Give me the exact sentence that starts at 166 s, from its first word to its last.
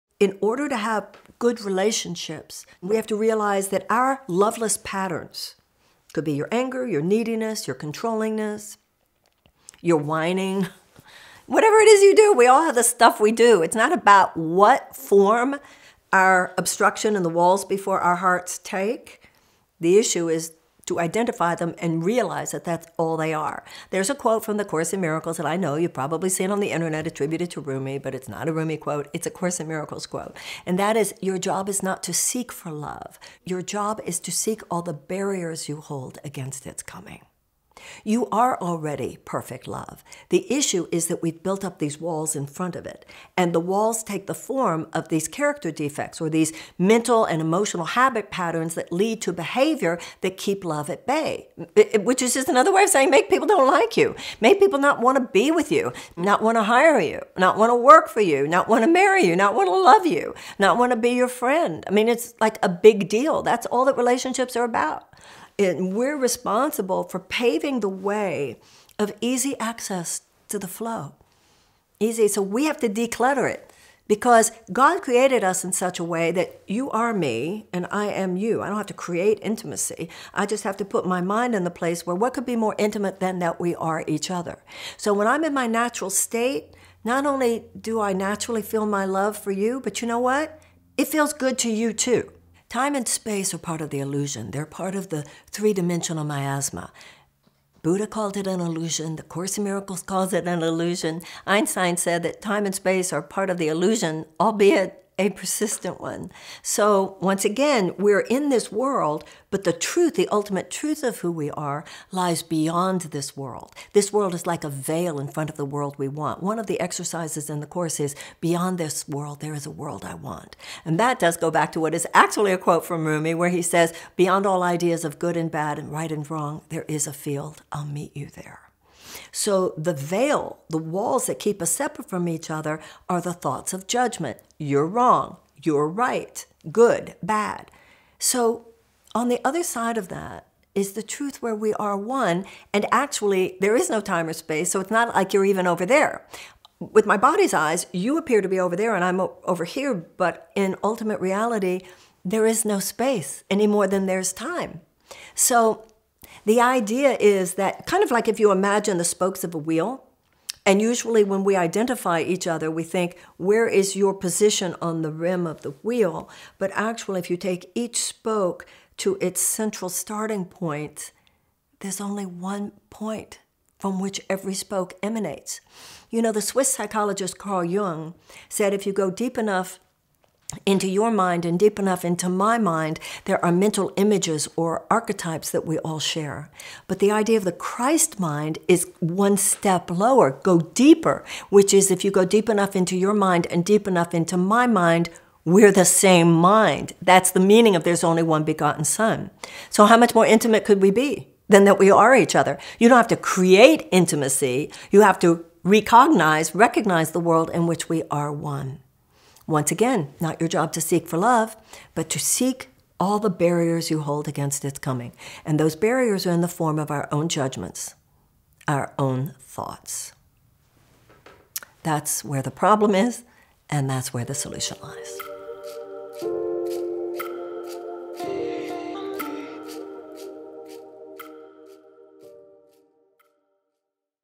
But actually, if you take each spoke to its central starting point, there's only one point from which every spoke emanates.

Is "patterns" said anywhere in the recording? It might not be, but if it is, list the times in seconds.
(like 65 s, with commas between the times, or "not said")
4 s, 48 s.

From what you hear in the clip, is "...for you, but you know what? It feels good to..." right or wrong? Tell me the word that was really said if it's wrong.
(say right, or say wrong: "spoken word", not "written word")
right.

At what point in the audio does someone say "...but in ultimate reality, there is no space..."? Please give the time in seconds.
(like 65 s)
149 s.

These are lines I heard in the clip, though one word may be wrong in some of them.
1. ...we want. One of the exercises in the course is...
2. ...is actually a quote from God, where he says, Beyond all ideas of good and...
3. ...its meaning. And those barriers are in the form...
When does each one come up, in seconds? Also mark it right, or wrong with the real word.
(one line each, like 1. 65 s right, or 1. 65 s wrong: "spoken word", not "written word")
1. 115 s right
2. 121 s wrong: "Rumi", not "God"
3. 214 s wrong: "coming", not "meaning".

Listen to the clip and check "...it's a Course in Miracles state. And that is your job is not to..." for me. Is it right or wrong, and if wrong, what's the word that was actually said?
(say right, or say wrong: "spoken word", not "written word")
wrong: "quote", not "state".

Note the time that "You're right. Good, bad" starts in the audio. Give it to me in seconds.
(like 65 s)
135 s.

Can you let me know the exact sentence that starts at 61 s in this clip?
I mean, it's like a big deal.